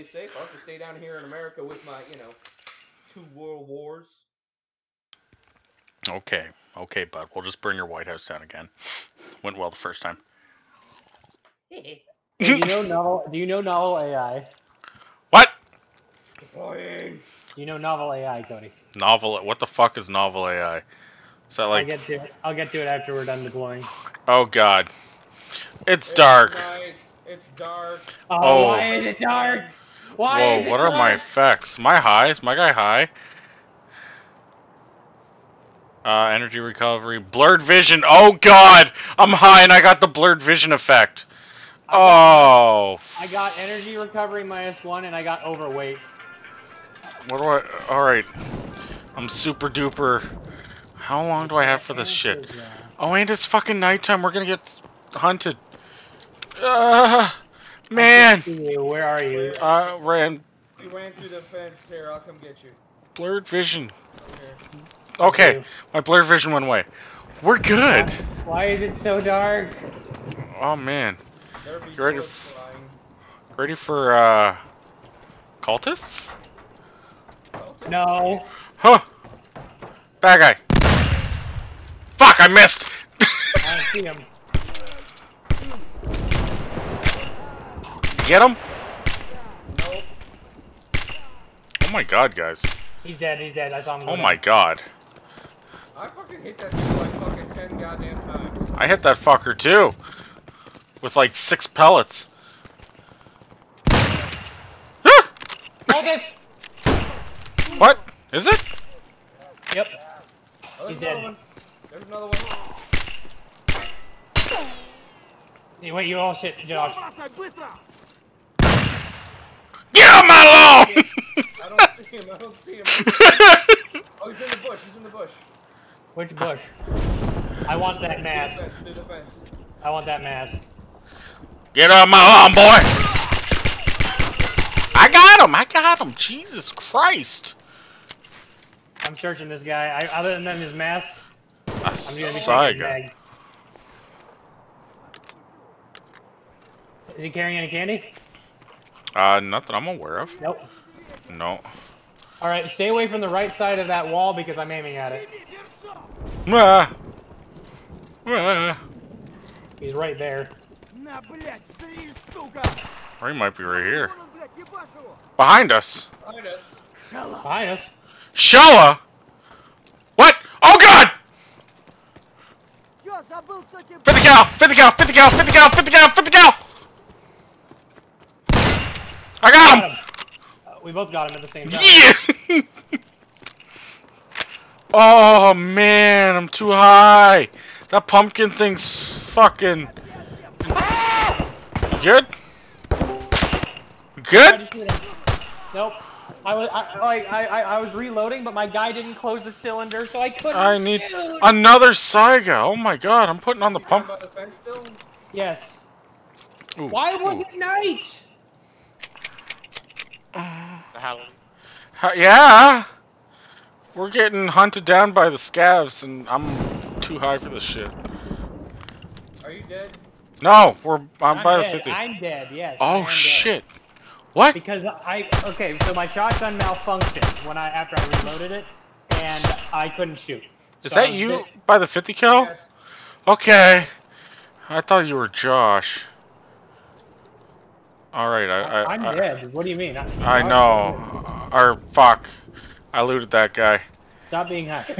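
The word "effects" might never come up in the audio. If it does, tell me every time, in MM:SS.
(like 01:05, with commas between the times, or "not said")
00:31, 00:40.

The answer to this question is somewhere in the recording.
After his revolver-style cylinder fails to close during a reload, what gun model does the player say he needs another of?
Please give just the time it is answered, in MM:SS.
03:21.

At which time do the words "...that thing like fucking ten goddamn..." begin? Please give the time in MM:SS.
01:36.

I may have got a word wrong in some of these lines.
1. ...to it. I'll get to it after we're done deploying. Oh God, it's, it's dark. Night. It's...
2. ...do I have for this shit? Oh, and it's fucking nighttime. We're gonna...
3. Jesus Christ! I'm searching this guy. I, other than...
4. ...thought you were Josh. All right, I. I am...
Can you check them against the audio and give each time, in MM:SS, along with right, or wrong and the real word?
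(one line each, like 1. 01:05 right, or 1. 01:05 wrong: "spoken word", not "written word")
1. 00:22 right
2. 00:51 right
3. 02:16 right
4. 03:54 right.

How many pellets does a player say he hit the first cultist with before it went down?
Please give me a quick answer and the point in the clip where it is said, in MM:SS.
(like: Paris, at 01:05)
6, at 01:41.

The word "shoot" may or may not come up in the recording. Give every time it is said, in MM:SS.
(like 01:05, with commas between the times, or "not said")
03:20, 03:50.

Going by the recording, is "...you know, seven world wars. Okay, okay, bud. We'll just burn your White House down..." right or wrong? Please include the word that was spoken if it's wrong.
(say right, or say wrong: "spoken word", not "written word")
wrong: "two", not "seven".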